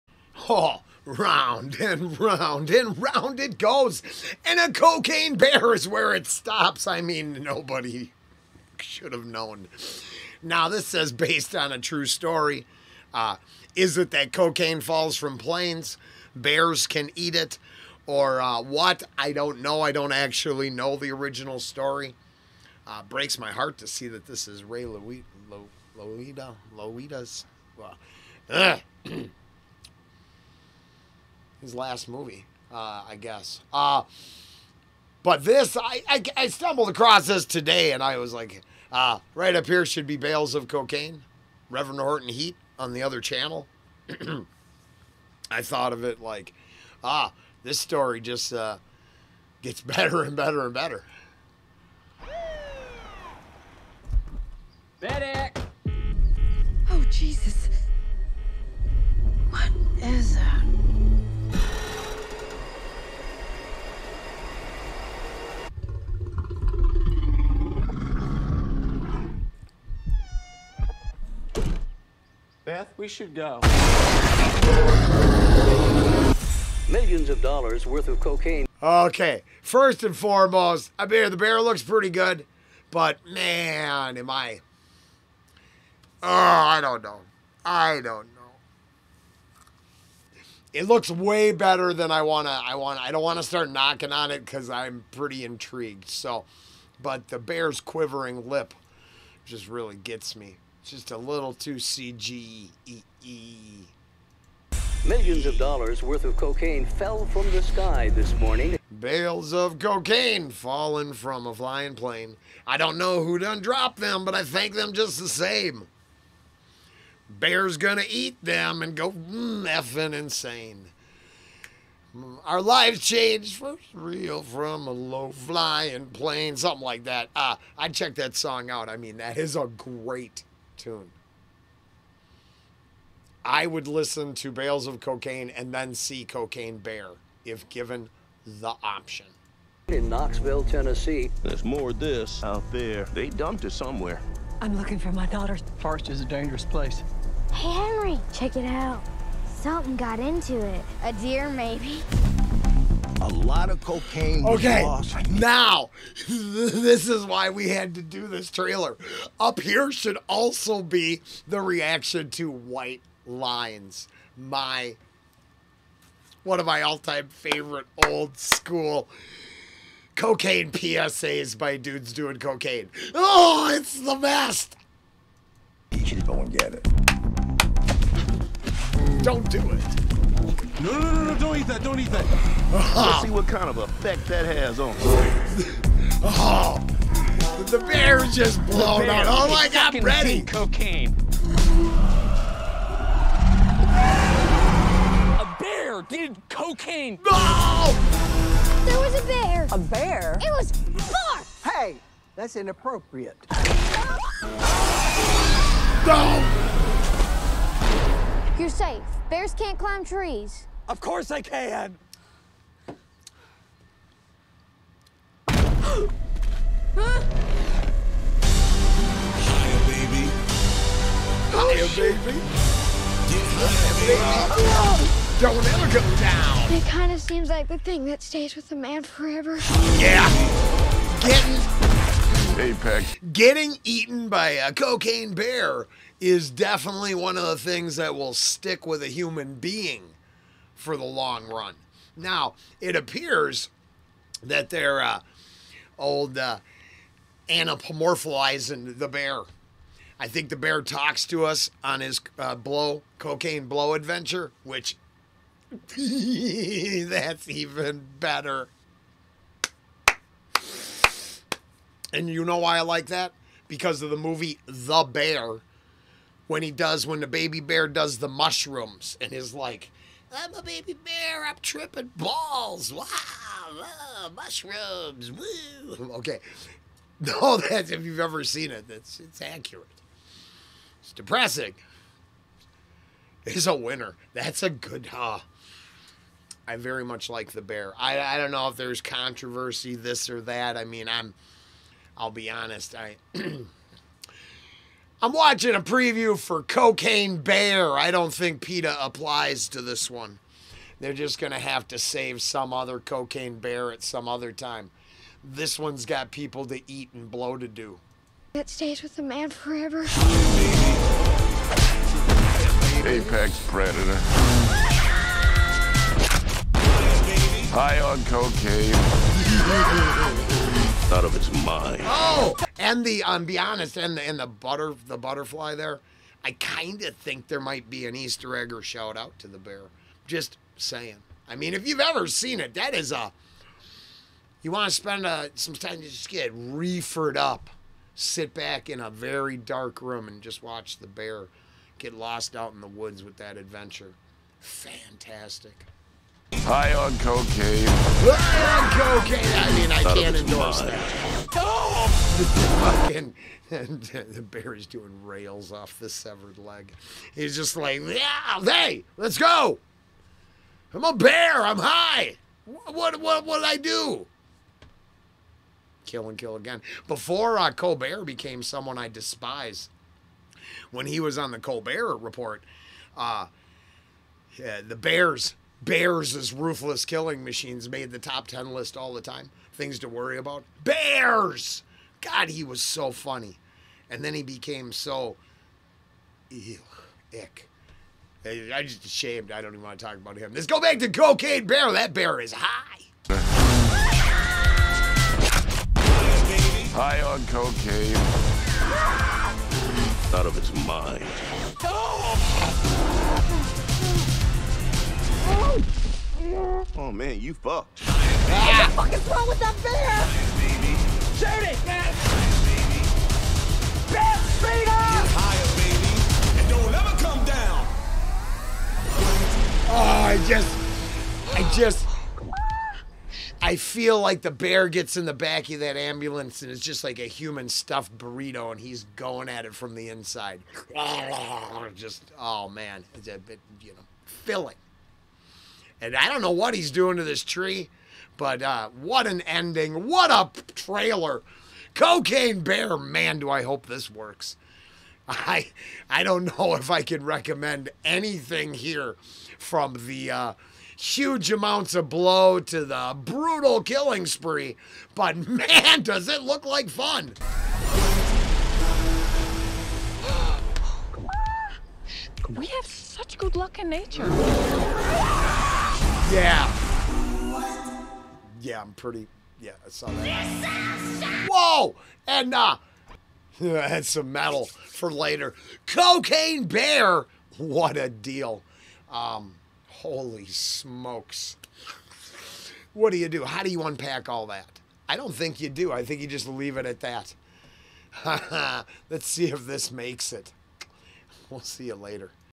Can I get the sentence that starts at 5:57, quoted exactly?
He's just like, yeah, hey, let's go.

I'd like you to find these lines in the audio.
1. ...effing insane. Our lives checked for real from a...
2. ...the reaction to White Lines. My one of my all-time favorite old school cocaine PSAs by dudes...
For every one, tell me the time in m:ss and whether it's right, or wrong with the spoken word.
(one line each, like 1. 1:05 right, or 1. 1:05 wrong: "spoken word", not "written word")
1. 1:59 wrong: "changed", not "checked"
2. 2:41 right.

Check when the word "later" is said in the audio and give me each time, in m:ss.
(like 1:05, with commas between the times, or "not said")
7:55, 8:11.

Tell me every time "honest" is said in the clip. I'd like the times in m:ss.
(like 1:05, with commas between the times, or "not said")
4:52, 5:23.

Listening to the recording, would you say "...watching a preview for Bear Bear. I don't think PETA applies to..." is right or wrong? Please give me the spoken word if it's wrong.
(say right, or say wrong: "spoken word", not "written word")
wrong: "Cocaine", not "Bear".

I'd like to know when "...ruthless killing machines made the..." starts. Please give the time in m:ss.
6:16.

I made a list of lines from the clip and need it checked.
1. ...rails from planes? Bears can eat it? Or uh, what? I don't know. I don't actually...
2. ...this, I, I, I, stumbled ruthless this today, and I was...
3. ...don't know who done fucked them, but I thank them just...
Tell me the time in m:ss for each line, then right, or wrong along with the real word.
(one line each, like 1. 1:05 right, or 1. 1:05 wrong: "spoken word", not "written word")
1. 0:14 wrong: "falls", not "rails"
2. 0:35 wrong: "across", not "ruthless"
3. 1:52 wrong: "dropped", not "fucked".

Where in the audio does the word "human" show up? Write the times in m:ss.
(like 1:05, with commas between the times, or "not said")
3:59, 7:07.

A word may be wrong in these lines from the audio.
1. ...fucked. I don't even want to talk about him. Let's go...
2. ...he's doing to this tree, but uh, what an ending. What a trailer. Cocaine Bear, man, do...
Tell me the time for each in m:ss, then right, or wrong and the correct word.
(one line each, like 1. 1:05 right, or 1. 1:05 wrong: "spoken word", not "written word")
1. 6:29 wrong: "ashamed", not "fucked"
2. 7:16 right.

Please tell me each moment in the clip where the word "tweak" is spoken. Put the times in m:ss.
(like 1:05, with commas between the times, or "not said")
not said.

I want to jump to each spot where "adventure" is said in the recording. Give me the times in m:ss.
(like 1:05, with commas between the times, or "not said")
4:13, 5:43.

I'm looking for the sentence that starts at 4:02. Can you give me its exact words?
Now, it appears that they're uh, old uh, anapomorphizing the bear.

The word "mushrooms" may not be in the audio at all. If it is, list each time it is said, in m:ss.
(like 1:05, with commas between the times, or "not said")
4:28, 4:34.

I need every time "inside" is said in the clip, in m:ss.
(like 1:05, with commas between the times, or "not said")
7:10.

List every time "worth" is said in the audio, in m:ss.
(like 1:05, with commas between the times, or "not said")
1:17, 1:46.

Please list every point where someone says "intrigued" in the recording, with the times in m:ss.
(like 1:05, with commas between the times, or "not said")
1:35.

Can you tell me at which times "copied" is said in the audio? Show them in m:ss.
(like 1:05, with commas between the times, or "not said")
not said.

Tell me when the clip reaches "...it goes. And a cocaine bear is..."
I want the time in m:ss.
0:03.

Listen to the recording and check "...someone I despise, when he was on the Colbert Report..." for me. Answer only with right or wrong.
right.